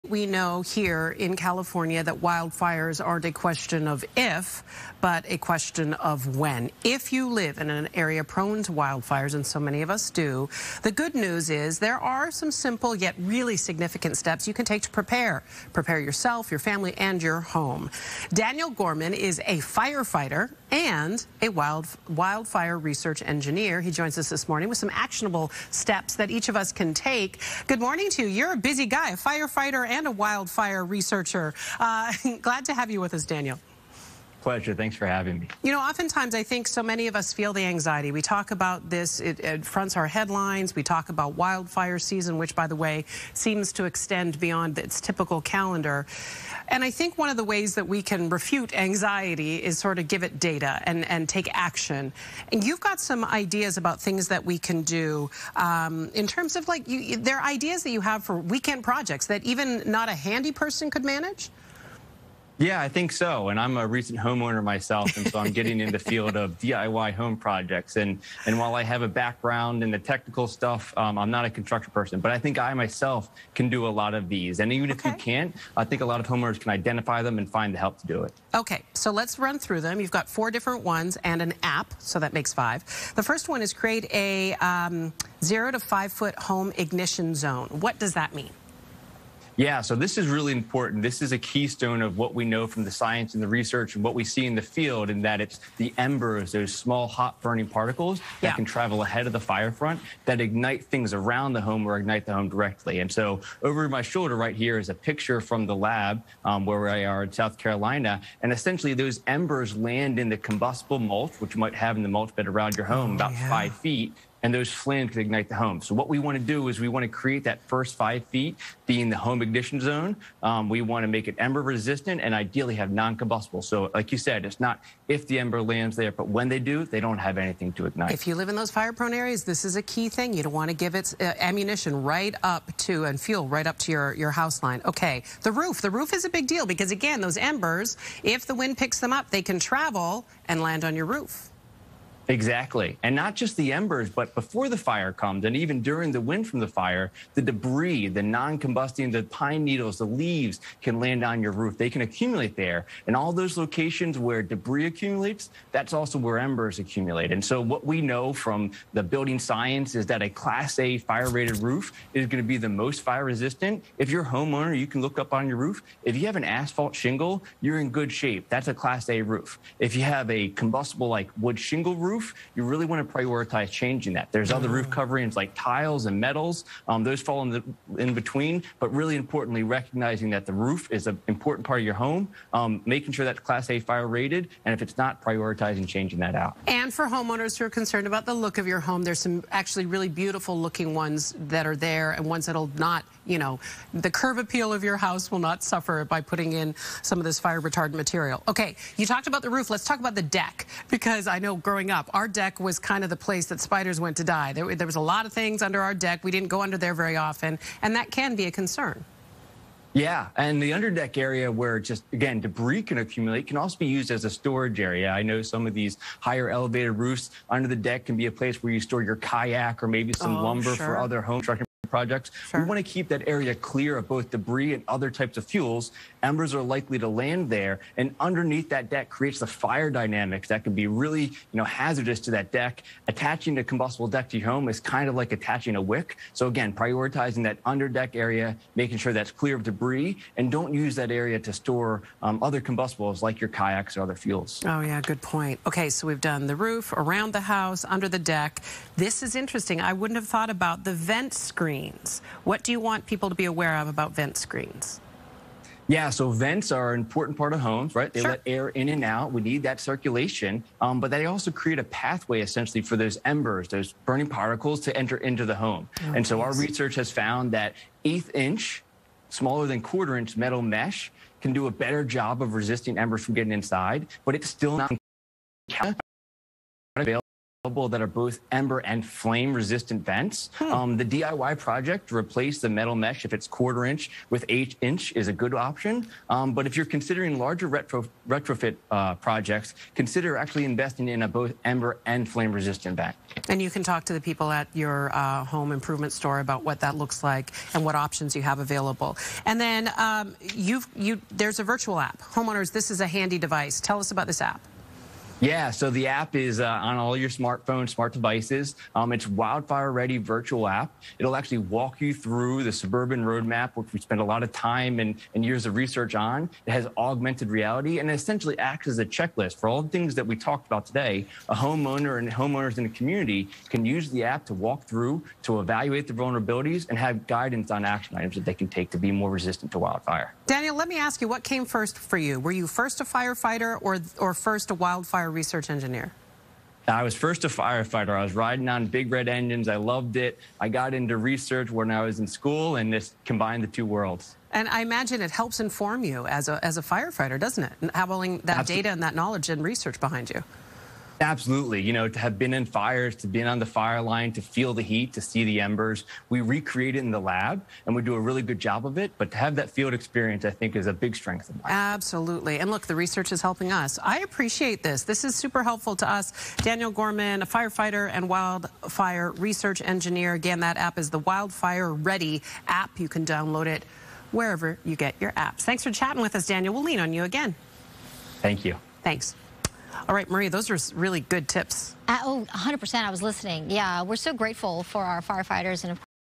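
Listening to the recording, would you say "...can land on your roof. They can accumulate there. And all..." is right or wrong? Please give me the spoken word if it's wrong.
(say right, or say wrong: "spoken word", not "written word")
right.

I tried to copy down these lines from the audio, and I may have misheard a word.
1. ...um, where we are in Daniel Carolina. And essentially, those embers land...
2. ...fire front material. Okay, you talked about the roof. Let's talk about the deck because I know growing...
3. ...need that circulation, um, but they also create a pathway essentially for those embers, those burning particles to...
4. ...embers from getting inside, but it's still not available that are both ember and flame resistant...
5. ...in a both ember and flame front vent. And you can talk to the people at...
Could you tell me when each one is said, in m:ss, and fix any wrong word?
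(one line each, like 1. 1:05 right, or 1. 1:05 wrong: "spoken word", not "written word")
1. 1:46 wrong: "South", not "Daniel"
2. 3:17 wrong: "retardant", not "front"
3. 4:19 right
4. 4:32 right
5. 4:51 wrong: "resistant", not "front".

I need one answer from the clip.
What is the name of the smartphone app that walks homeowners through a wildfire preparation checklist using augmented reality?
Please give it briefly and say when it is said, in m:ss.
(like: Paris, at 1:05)
Wildfire Ready Virtual App, at 5:09.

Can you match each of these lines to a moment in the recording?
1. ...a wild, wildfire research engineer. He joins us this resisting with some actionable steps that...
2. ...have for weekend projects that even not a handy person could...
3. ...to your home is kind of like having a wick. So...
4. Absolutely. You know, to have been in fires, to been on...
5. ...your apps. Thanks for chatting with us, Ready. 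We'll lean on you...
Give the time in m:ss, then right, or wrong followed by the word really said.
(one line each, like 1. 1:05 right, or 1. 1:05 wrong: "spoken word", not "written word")
1. 0:21 wrong: "morning", not "resisting"
2. 0:58 right
3. 3:54 wrong: "attaching", not "having"
4. 5:51 right
5. 6:15 wrong: "Daniel", not "Ready".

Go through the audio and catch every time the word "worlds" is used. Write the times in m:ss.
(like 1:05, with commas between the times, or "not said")
5:43.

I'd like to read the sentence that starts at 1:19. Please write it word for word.
You've got four different ones and an app, so that makes five.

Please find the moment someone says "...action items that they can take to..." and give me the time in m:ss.
5:27.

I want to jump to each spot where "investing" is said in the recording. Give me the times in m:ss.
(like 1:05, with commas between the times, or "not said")
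4:50.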